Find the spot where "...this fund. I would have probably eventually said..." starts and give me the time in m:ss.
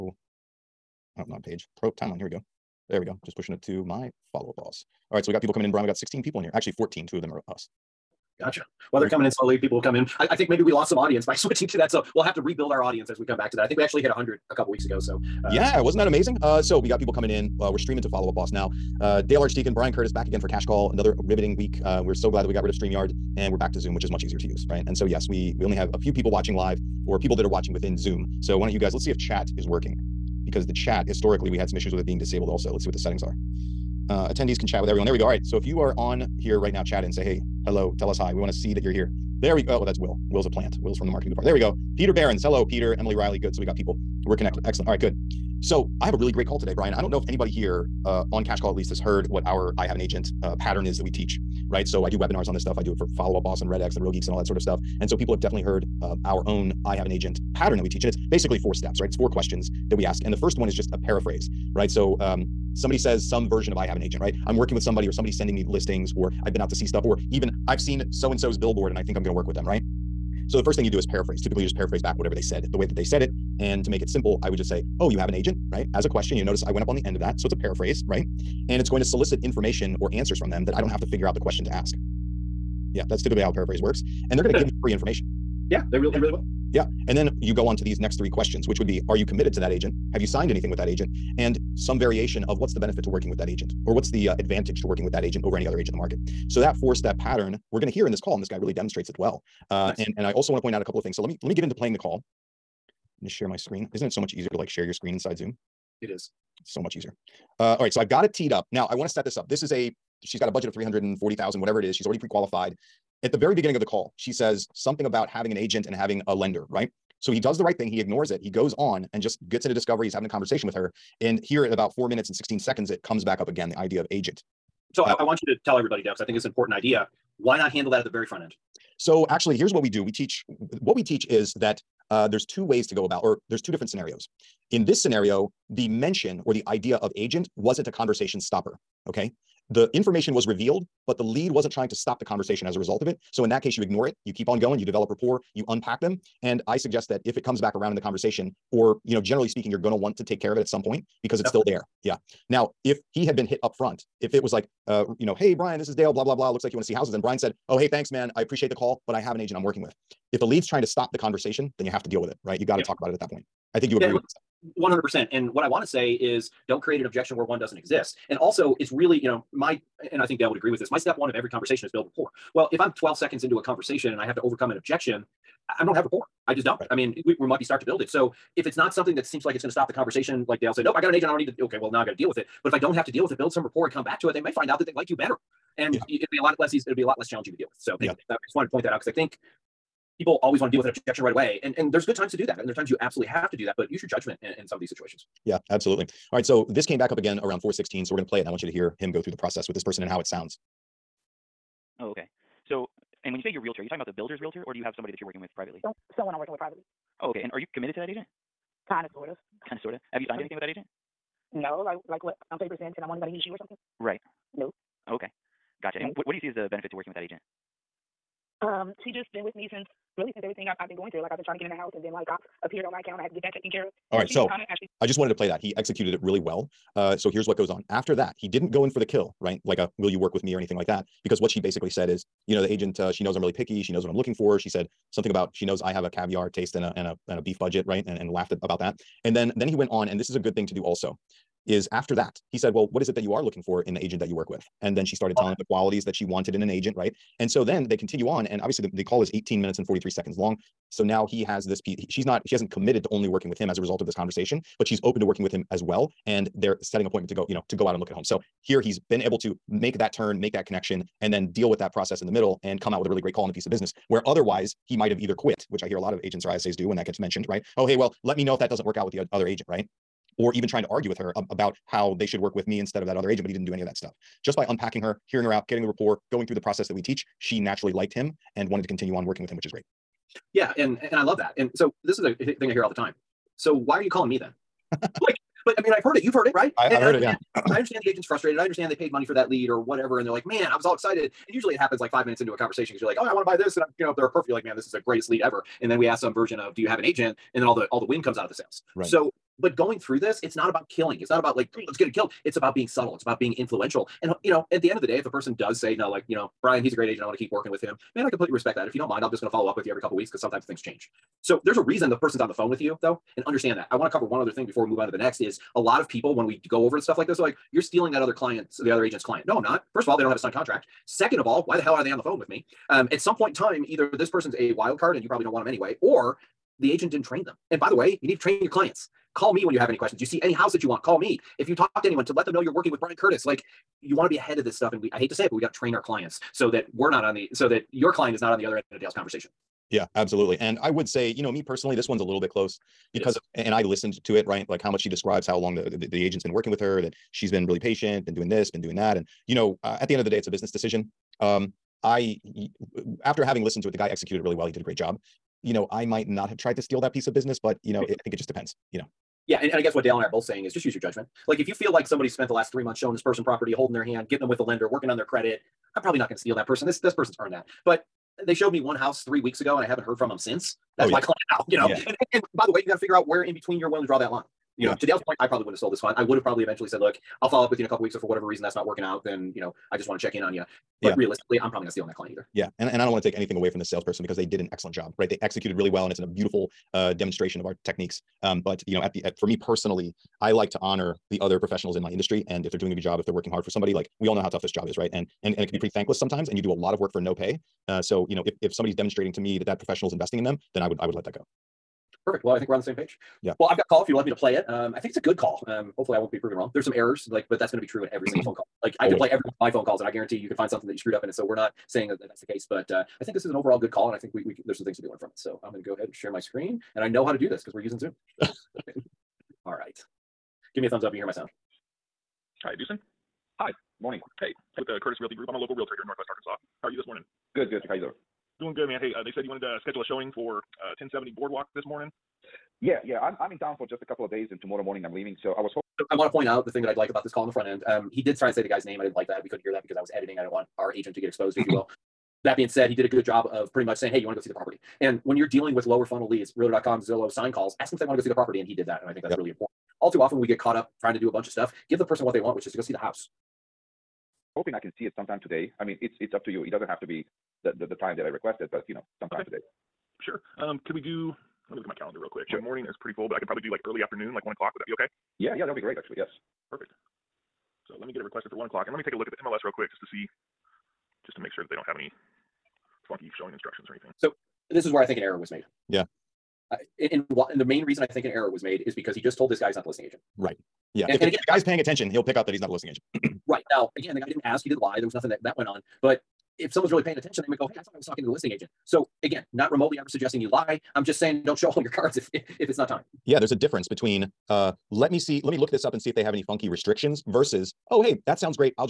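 6:15.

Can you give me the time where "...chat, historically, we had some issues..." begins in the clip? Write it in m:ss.
0:30.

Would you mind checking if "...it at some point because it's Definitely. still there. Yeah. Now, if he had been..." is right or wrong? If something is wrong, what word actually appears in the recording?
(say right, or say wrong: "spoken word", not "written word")
right.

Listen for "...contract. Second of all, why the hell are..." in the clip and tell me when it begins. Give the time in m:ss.
5:20.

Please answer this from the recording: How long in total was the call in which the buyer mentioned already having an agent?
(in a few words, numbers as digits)
18 minutes 43 seconds.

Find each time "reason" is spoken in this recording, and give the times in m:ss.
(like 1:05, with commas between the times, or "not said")
5:11, 6:18, 7:57.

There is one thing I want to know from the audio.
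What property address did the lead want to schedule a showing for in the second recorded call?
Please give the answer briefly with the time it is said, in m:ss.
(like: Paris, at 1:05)
1070 Boardwalk, at 7:10.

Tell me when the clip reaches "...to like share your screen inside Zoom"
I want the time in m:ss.
1:44.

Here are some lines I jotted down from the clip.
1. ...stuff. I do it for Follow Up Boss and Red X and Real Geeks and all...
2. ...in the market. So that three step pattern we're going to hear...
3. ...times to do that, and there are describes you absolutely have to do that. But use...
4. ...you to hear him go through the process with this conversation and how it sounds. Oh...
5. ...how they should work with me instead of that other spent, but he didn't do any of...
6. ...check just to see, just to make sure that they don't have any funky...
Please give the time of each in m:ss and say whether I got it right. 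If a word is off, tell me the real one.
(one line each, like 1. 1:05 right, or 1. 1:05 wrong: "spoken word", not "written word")
1. 0:52 right
2. 1:35 wrong: "four", not "three"
3. 3:12 wrong: "times", not "describes"
4. 3:18 wrong: "person", not "conversation"
5. 4:31 wrong: "agent", not "spent"
6. 7:49 wrong: "quick", not "check".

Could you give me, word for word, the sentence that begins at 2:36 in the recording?
Looks like you want to see houses, and Brian said, oh, hey, thanks, man.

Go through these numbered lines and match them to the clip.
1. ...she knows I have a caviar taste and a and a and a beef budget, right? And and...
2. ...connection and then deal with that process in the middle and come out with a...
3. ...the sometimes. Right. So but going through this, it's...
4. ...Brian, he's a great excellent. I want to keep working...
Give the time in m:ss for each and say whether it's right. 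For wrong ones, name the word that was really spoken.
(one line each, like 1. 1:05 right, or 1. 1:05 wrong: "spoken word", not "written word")
1. 3:55 right
2. 4:20 right
3. 4:58 wrong: "sales", not "sometimes"
4. 5:06 wrong: "agent", not "excellent".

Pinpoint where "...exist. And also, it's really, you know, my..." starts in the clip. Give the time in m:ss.
2:47.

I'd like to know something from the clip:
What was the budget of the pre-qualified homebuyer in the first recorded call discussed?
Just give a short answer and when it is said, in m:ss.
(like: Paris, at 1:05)
340,000, at 1:50.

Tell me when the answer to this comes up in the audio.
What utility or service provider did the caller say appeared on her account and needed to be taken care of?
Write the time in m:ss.
3:42.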